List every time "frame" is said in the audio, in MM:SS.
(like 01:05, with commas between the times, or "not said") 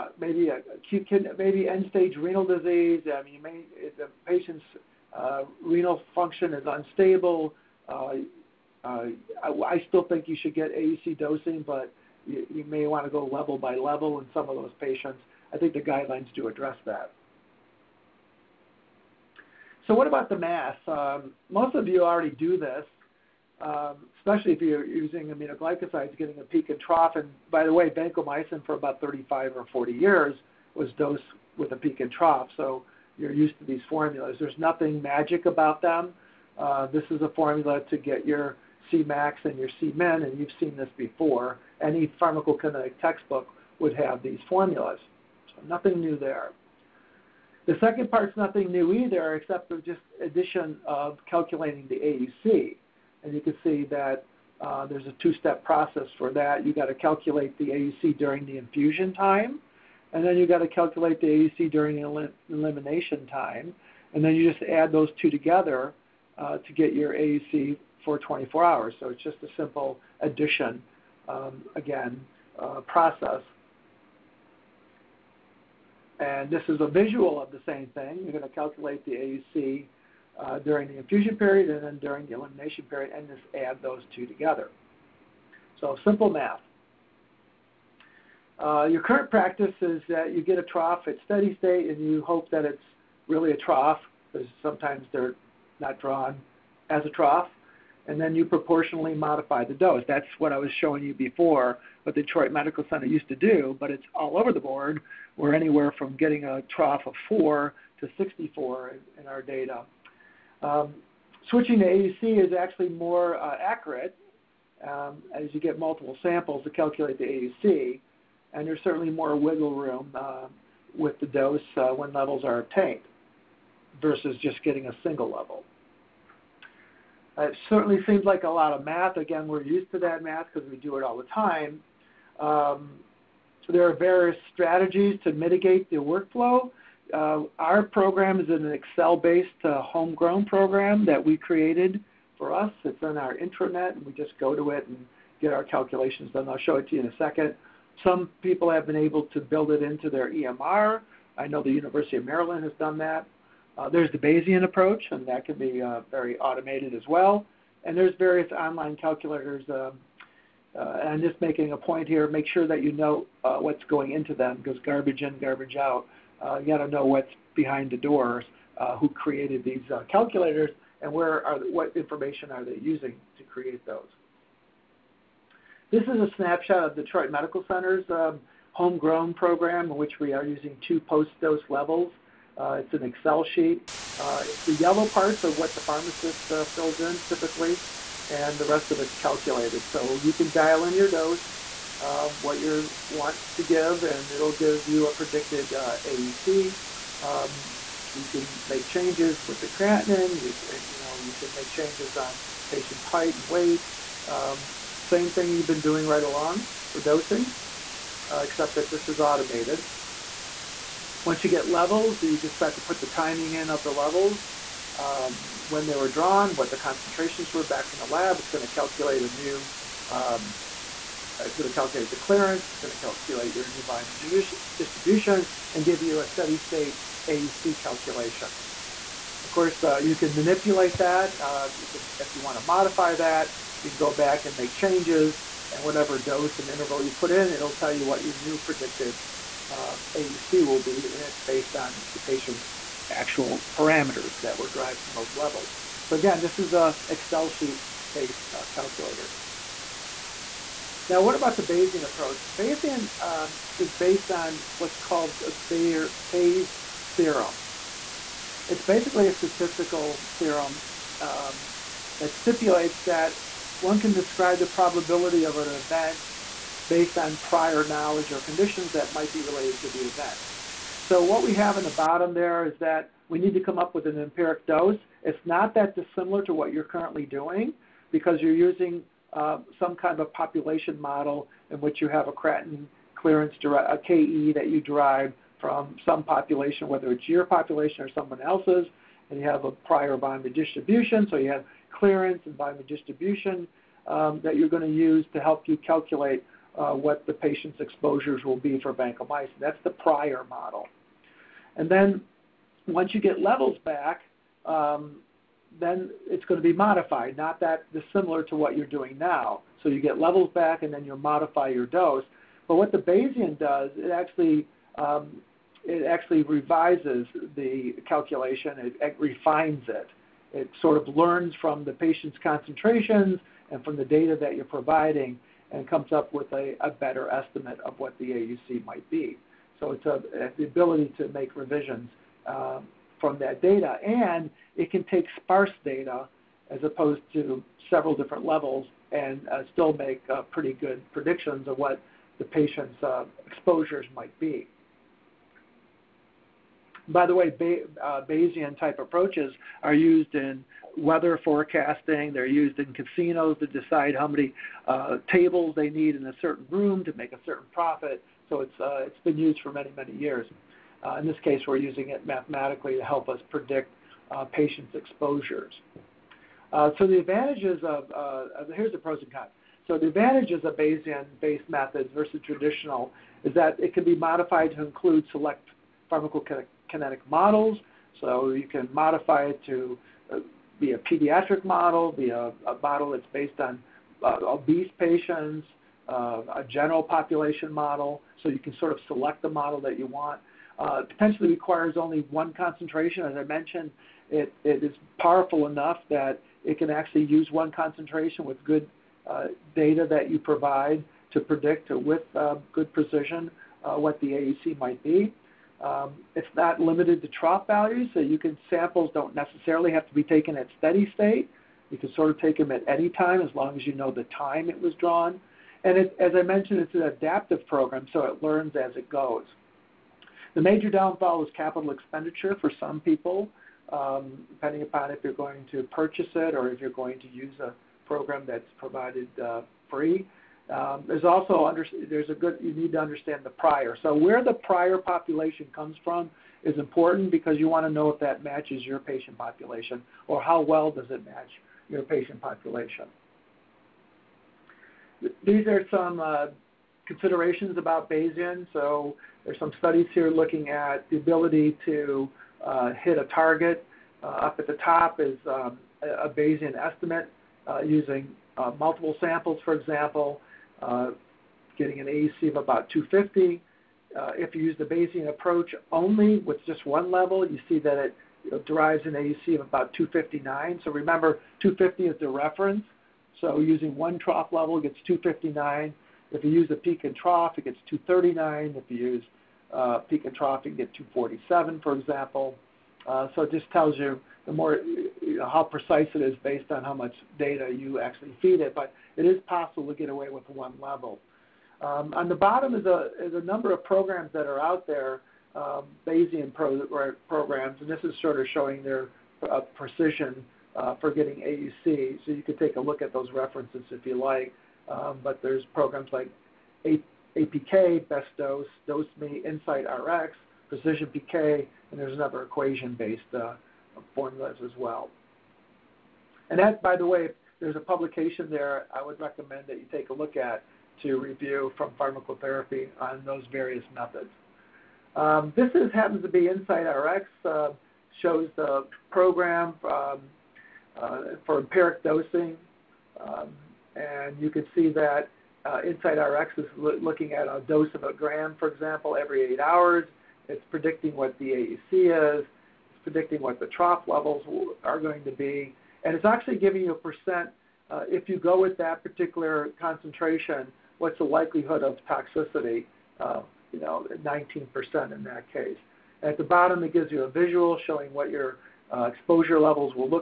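not said.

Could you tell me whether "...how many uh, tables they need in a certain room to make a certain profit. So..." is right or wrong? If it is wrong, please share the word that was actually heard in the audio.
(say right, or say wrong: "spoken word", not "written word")
right.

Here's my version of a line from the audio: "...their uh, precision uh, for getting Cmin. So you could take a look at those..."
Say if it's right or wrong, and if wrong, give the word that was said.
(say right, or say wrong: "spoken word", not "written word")
wrong: "AUC", not "Cmin".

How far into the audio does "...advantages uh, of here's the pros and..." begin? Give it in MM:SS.
06:07.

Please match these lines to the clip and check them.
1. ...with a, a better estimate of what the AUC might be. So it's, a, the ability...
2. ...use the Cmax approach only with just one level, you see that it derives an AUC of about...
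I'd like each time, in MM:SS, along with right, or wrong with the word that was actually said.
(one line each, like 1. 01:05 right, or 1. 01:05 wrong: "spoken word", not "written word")
1. 05:26 right
2. 07:44 wrong: "Bayesian", not "Cmax".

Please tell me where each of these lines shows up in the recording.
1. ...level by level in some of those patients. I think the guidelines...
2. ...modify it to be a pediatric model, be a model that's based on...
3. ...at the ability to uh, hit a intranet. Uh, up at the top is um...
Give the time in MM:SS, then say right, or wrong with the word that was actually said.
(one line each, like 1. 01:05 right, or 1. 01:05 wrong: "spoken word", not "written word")
1. 00:13 right
2. 06:18 right
3. 07:30 wrong: "target", not "intranet".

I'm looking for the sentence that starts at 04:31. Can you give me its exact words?
So what we have in the bottom there is that we need to come up with an empiric dose.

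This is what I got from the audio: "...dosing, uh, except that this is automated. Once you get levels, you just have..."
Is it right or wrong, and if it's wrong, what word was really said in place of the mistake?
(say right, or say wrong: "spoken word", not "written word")
right.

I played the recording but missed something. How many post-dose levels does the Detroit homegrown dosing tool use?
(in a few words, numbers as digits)
2.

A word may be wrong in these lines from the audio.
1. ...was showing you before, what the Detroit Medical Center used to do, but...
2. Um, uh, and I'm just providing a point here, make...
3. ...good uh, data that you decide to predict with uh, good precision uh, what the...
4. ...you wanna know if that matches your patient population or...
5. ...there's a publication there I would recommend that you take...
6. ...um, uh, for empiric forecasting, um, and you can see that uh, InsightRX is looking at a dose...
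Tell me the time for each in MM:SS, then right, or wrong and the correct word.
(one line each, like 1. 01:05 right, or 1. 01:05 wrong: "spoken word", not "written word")
1. 01:40 right
2. 02:39 wrong: "making", not "providing"
3. 06:38 wrong: "provide", not "decide"
4. 07:17 right
5. 08:37 right
6. 08:49 wrong: "dosing", not "forecasting".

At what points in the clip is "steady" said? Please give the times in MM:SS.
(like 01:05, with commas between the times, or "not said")
01:31, 03:46, 06:50.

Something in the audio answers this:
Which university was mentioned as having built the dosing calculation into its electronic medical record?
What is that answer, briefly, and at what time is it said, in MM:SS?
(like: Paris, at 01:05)
University of Maryland, at 02:31.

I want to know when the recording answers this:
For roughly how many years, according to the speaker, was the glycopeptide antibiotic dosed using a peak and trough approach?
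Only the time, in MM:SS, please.
00:29.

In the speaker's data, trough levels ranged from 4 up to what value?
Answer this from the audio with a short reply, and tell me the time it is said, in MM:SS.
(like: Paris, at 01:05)
64, at 01:47.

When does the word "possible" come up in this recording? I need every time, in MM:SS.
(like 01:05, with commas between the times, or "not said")
08:09.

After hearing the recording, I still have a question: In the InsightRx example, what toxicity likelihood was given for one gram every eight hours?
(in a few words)
19%.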